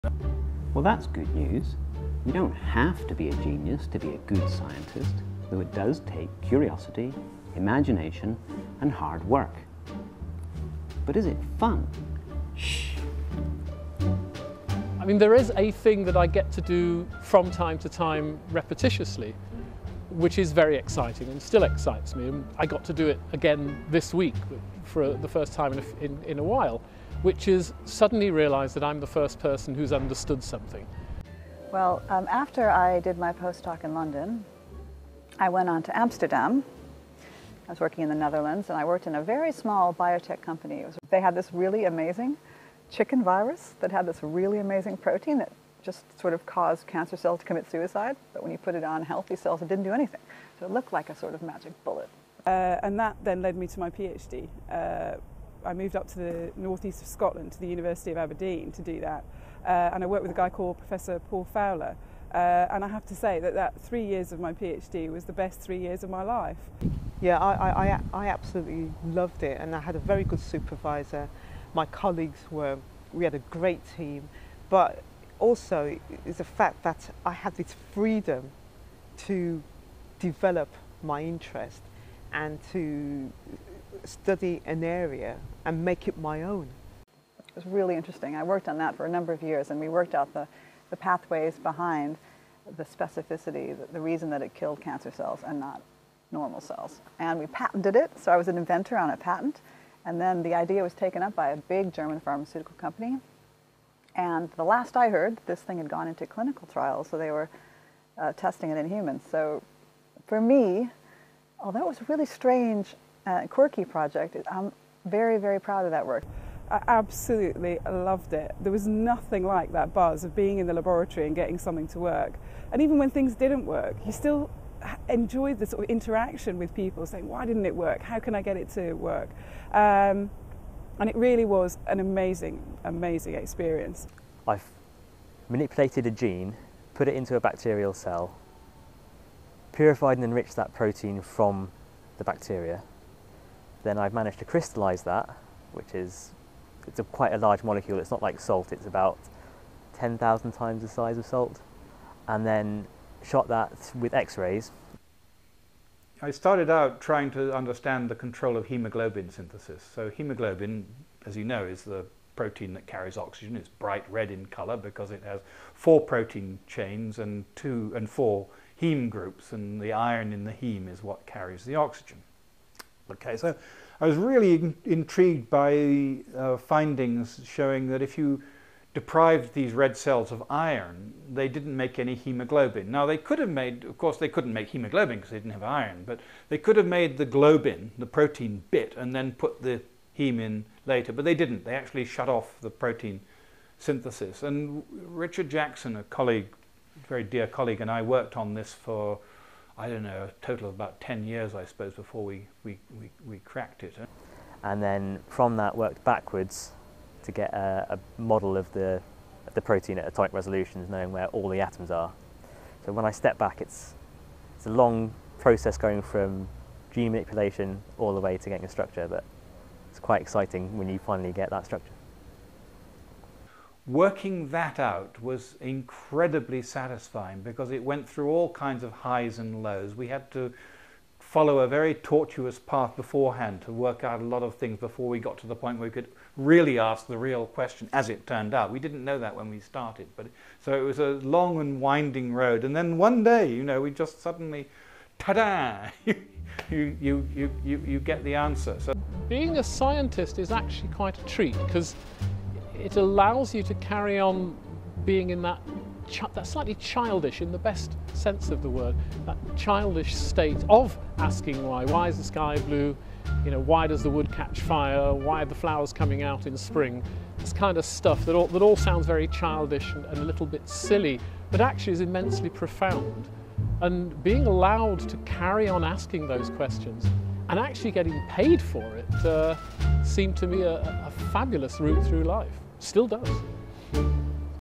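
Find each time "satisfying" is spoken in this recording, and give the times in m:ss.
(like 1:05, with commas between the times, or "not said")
3:46.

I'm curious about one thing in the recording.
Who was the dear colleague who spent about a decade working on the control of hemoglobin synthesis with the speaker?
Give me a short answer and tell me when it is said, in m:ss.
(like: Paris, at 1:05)
Richard Jackson, at 3:15.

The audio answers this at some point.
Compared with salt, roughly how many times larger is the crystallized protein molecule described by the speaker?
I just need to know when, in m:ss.
2:29.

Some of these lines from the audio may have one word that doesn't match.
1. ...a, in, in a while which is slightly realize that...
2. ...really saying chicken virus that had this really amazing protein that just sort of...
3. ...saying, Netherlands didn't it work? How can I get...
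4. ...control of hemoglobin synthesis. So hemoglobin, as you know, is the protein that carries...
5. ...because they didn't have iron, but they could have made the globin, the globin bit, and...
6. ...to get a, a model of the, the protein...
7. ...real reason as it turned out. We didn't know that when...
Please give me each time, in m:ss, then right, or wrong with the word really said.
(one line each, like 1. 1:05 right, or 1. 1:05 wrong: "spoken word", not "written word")
1. 0:25 wrong: "suddenly", not "slightly"
2. 0:41 wrong: "amazing", not "saying"
3. 2:07 wrong: "Why", not "Netherlands"
4. 2:38 right
5. 3:05 wrong: "protein", not "globin"
6. 3:27 right
7. 3:57 wrong: "question", not "reason".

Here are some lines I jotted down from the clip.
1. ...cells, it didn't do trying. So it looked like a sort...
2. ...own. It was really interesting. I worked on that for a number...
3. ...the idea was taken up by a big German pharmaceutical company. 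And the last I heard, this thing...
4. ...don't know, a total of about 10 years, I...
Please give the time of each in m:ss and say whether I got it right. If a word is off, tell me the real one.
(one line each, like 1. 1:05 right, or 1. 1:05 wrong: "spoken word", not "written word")
1. 0:49 wrong: "anything", not "trying"
2. 1:26 right
3. 1:40 right
4. 3:19 right.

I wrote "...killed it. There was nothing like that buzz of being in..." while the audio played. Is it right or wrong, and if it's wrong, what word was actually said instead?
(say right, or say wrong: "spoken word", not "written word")
wrong: "loved", not "killed".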